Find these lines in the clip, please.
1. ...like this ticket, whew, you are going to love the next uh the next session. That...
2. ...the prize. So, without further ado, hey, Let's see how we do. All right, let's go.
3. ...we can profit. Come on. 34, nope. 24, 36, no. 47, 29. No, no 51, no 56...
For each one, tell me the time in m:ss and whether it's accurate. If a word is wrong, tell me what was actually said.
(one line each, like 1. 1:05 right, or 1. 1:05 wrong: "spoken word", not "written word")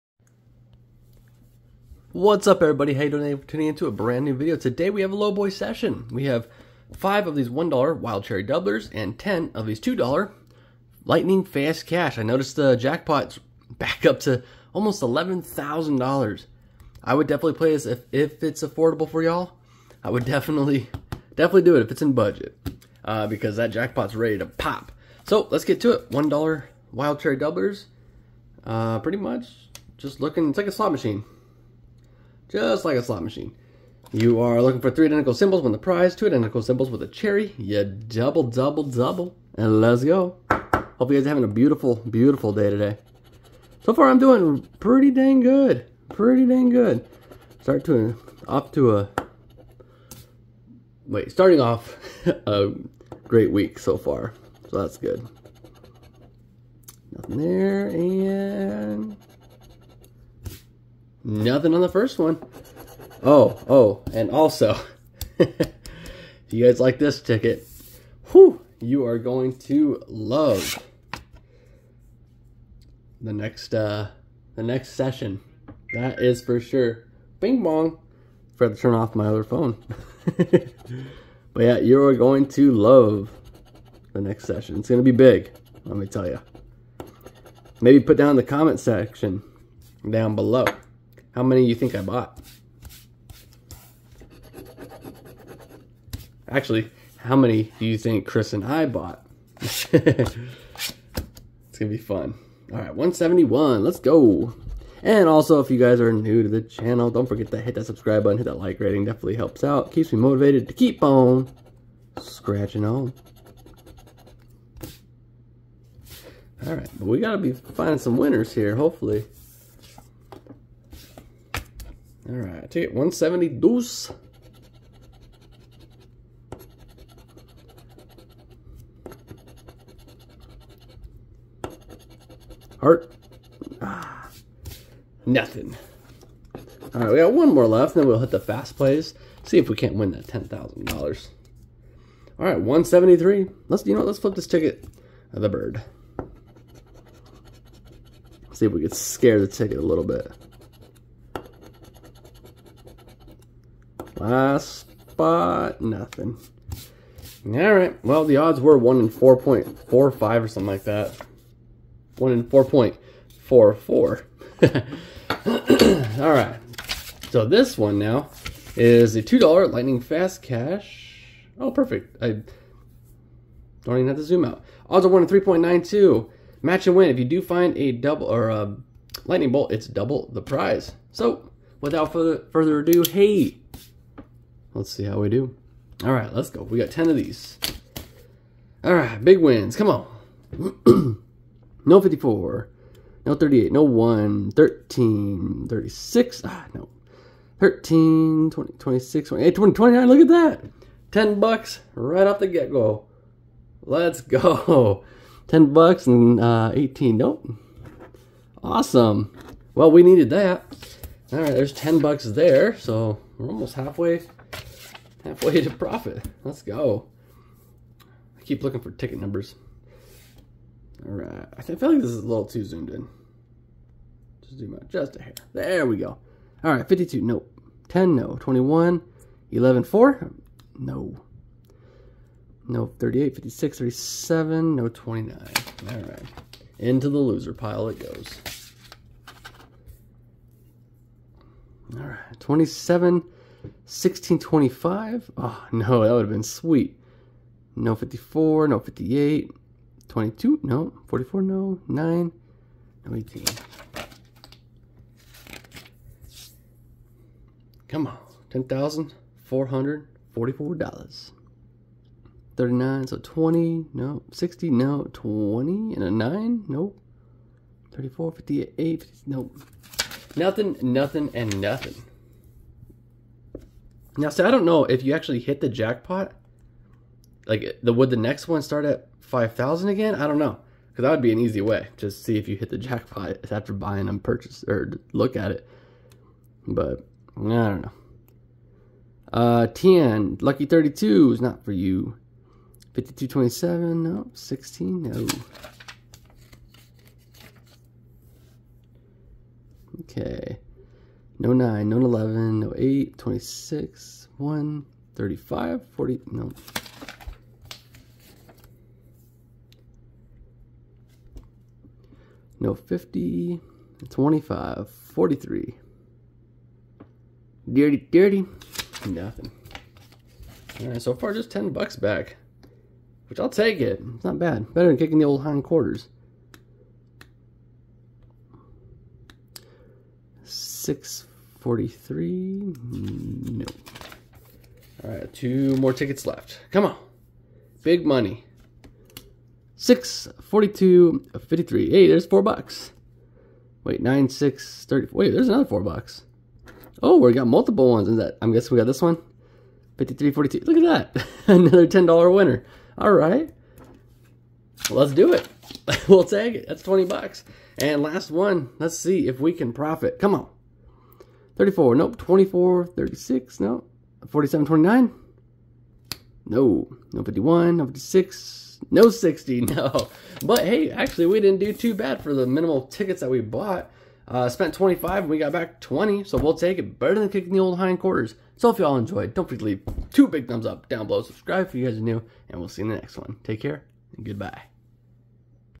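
1. 1:06 right
2. 3:00 right
3. 5:59 right.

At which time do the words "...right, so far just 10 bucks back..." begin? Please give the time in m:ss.
5:20.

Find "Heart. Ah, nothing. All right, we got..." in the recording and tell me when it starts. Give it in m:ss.
2:12.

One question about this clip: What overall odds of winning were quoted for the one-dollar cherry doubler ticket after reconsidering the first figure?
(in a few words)
1 in 4.44.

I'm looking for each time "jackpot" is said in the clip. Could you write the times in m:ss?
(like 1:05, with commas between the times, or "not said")
0:12, 0:23, 4:35, 4:42.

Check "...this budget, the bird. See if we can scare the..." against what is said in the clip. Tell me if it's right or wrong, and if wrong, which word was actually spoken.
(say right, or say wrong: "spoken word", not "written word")
wrong: "ticket", not "budget".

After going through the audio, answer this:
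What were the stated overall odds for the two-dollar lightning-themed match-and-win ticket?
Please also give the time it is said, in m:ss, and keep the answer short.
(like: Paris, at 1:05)
1 in 3.92, at 2:55.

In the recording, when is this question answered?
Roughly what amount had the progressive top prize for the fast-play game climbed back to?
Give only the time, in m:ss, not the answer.
0:15.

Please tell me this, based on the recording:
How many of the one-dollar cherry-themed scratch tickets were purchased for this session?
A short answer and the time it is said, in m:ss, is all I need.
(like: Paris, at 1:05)
5, at 0:06.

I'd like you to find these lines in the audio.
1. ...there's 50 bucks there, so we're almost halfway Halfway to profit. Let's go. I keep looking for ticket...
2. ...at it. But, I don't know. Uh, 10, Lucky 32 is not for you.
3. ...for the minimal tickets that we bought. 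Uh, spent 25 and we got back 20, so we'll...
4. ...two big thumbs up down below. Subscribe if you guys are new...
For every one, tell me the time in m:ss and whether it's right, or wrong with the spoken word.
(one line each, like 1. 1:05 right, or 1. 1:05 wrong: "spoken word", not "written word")
1. 3:31 wrong: "10", not "50"
2. 4:45 right
3. 6:12 right
4. 6:20 right.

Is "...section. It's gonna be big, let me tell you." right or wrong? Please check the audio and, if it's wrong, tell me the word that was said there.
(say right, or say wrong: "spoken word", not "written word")
wrong: "session", not "section".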